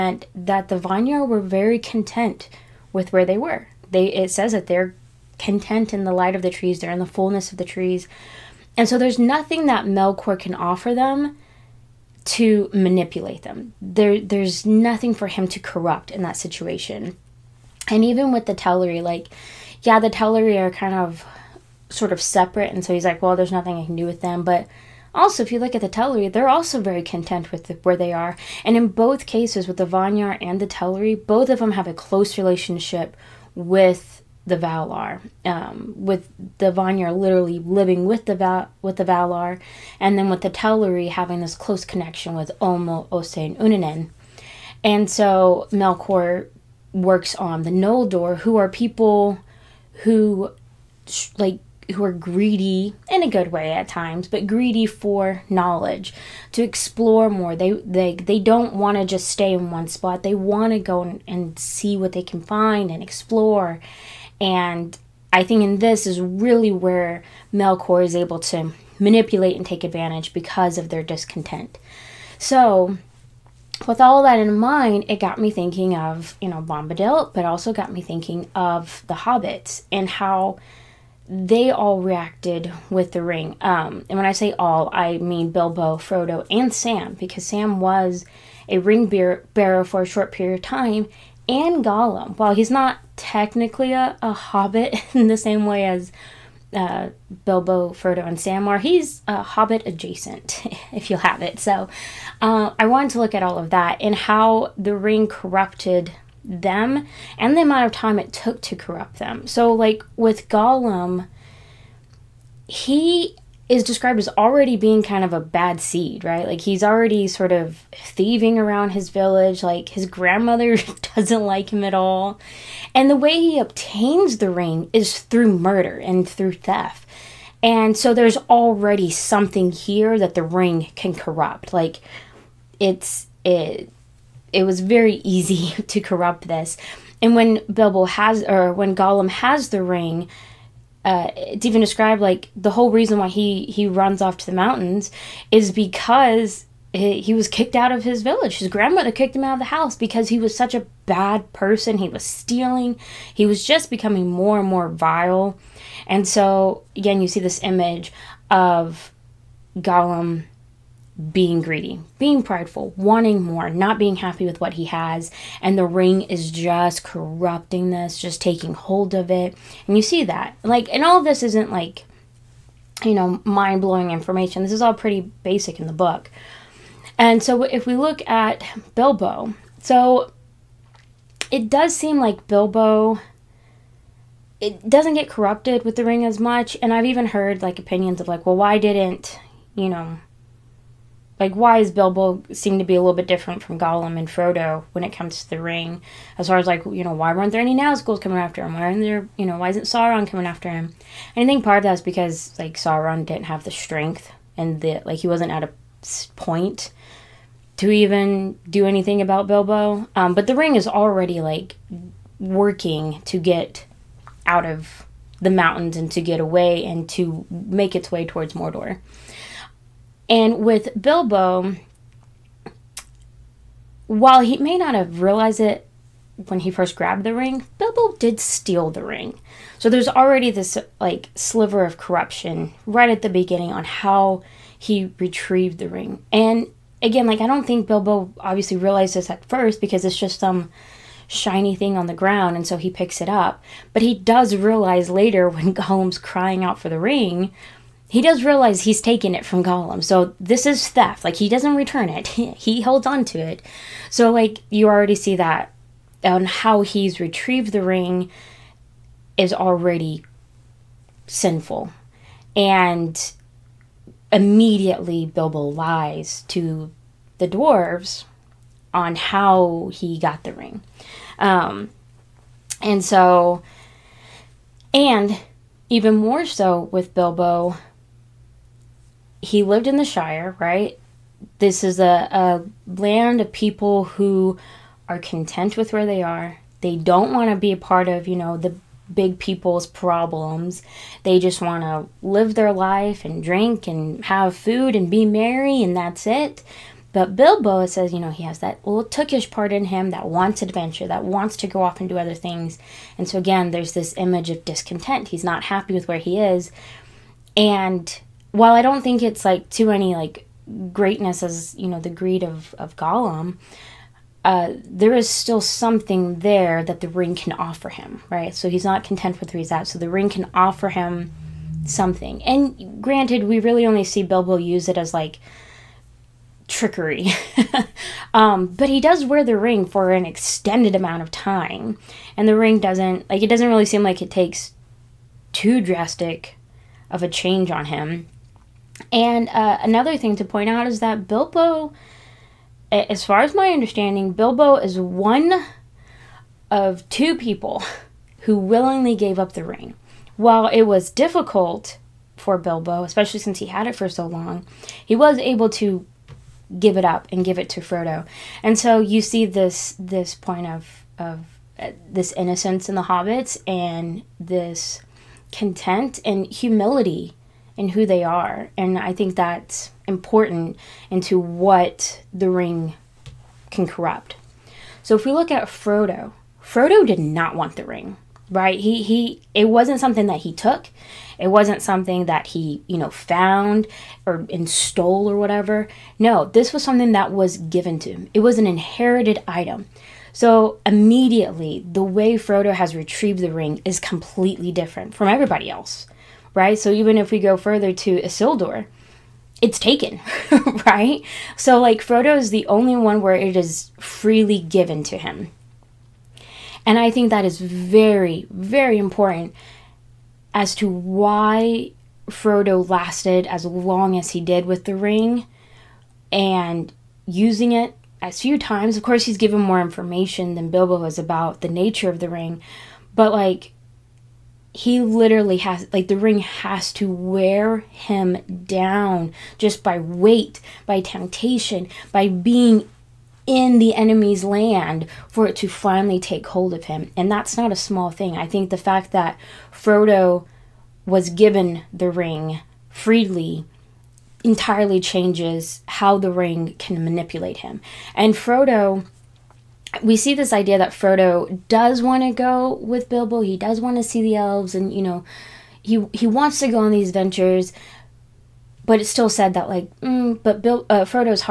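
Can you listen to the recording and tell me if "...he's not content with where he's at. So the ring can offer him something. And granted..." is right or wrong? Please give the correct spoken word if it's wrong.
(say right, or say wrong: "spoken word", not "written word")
right.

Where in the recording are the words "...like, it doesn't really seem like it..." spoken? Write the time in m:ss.
5:33.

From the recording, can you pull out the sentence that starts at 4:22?
And immediately Bilbo lies to the dwarves on how he got the ring.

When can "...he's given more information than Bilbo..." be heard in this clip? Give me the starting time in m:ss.
6:59.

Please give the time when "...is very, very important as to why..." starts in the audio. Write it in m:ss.
6:47.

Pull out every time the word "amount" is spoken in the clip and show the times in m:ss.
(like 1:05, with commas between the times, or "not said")
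1:47, 5:30.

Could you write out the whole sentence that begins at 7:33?
He does want to see the elves, and you know, he he wants to go on these ventures.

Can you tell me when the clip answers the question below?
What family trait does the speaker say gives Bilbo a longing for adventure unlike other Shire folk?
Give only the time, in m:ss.
4:59.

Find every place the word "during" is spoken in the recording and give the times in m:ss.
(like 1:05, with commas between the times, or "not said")
not said.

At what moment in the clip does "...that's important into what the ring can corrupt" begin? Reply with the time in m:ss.
6:09.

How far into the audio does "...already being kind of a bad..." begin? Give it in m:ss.
1:54.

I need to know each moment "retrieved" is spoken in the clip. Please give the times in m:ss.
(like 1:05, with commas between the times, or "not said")
3:55, 4:17, 6:32.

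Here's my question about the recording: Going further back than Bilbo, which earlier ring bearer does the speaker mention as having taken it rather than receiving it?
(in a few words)
Isildur.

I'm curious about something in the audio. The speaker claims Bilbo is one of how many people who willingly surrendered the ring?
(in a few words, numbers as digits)
2.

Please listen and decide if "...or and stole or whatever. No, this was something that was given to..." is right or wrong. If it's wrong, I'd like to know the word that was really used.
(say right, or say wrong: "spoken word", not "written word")
right.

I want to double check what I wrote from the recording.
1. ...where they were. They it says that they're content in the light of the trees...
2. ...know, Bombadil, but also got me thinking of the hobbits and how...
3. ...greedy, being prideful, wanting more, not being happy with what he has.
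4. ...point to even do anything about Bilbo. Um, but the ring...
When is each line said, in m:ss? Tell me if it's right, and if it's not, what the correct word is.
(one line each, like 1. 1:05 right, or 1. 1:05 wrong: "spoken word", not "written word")
1. 0:03 right
2. 1:16 right
3. 2:41 right
4. 3:26 right.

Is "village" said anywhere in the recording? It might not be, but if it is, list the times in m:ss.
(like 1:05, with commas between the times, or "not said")
1:59, 2:28.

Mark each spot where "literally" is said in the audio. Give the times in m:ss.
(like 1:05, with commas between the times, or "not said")
0:37, 7:05.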